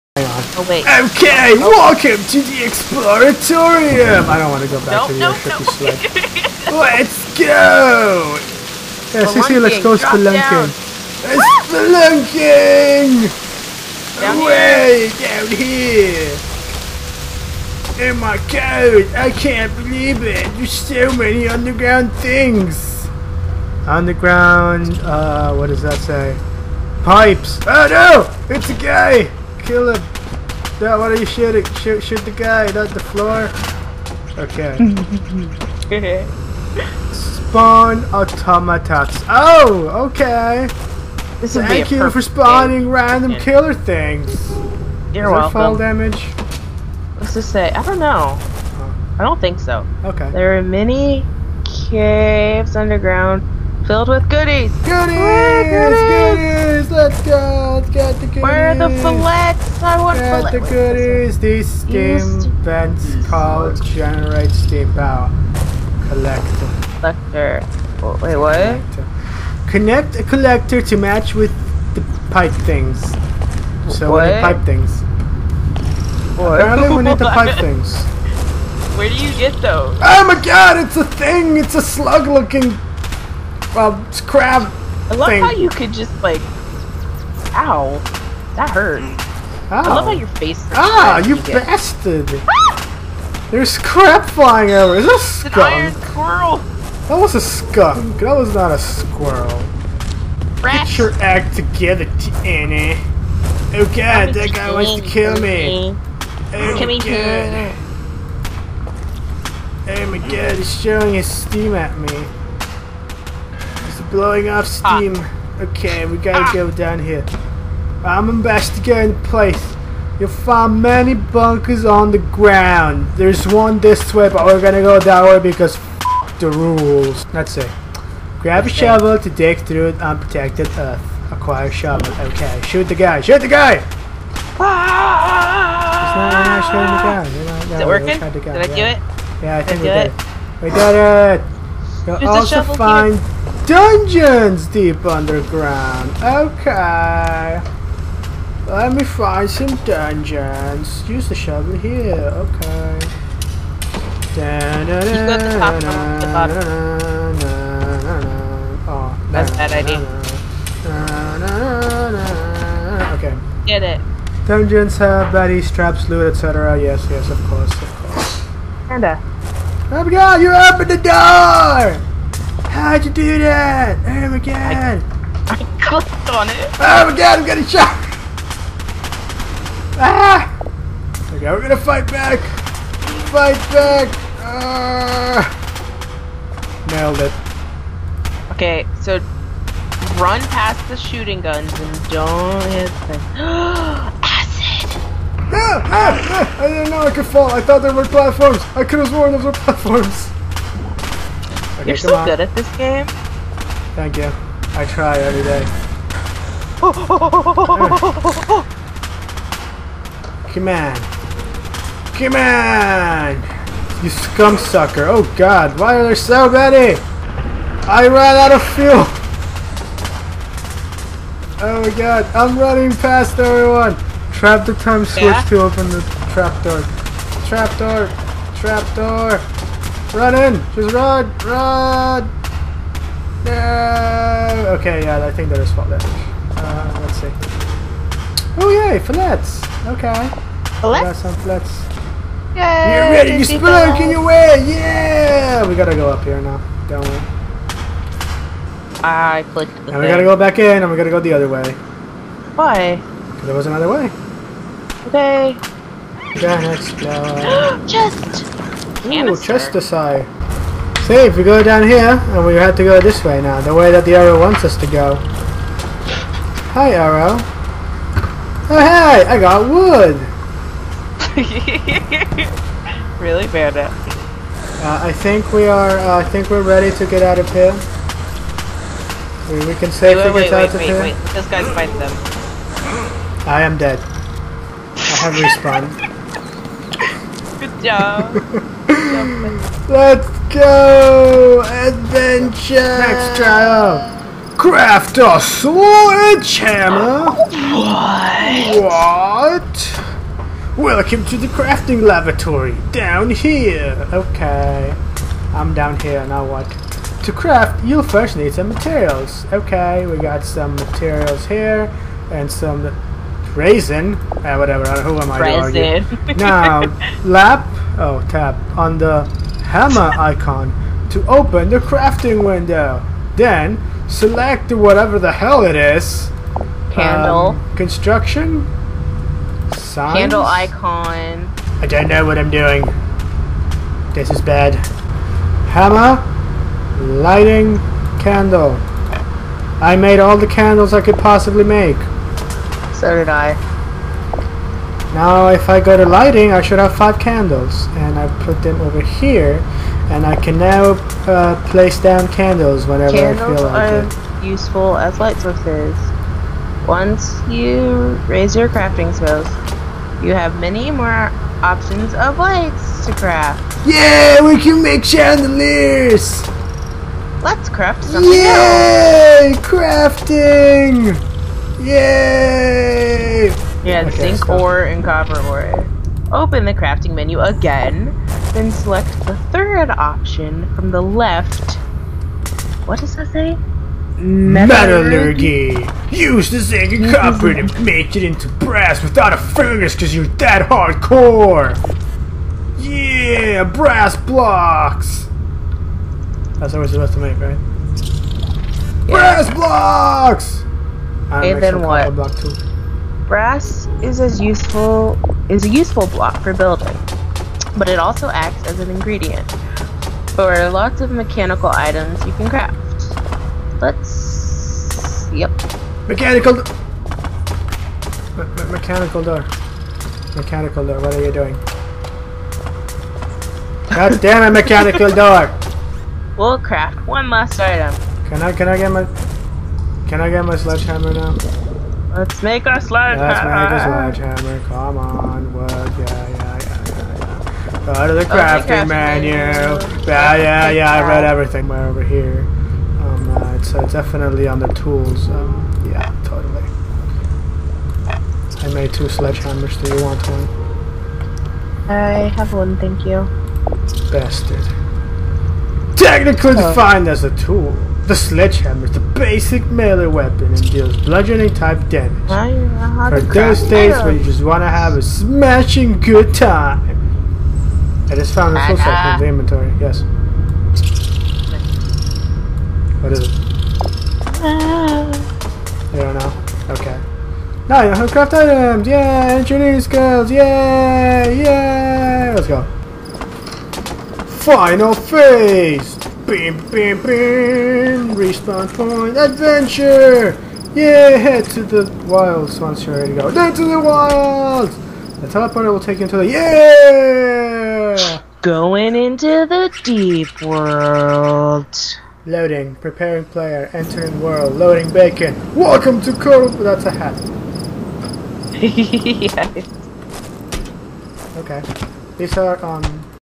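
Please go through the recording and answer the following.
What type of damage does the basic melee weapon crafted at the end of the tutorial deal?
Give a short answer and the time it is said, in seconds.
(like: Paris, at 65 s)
bludgeoning, at 460 s.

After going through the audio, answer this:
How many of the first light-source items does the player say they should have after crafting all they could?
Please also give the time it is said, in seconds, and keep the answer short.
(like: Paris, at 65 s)
5, at 346 s.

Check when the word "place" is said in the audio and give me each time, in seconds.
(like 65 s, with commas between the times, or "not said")
119 s, 351 s.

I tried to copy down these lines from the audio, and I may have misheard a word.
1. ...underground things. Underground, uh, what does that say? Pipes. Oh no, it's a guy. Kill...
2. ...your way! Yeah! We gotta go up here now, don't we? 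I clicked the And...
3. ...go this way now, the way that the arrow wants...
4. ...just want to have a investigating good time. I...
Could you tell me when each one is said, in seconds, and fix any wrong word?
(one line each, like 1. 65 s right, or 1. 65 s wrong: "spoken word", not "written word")
1. 21 s right
2. 244 s right
3. 262 s right
4. 464 s wrong: "smashing", not "investigating".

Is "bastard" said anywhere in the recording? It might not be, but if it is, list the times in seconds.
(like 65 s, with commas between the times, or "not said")
91 s, 454 s.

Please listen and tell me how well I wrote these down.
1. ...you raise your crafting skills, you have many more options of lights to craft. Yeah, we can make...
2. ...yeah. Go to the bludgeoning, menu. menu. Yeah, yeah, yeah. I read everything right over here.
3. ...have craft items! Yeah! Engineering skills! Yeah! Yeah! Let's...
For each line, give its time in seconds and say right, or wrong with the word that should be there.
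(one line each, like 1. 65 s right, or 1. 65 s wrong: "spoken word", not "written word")
1. 357 s right
2. 437 s wrong: "crafting", not "bludgeoning"
3. 477 s right.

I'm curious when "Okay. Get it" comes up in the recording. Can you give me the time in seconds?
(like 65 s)
163 s.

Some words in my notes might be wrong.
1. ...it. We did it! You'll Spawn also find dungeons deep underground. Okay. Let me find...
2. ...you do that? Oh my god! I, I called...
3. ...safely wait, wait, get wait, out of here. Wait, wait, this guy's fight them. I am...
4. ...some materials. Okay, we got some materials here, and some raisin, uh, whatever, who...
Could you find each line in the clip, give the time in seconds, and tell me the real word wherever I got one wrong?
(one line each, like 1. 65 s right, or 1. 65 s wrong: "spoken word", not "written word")
1. 140 s wrong: "Use", not "Spawn"
2. 173 s wrong: "clicked", not "called"
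3. 279 s right
4. 308 s right.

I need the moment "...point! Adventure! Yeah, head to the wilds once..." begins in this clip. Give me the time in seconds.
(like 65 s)
488 s.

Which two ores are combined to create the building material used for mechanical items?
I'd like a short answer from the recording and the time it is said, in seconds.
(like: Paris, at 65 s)
zinc and copper, at 374 s.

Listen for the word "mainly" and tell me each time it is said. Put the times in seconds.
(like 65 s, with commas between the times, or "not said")
not said.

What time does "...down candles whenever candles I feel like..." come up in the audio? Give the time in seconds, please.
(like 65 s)
351 s.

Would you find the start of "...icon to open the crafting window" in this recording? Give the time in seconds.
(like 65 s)
320 s.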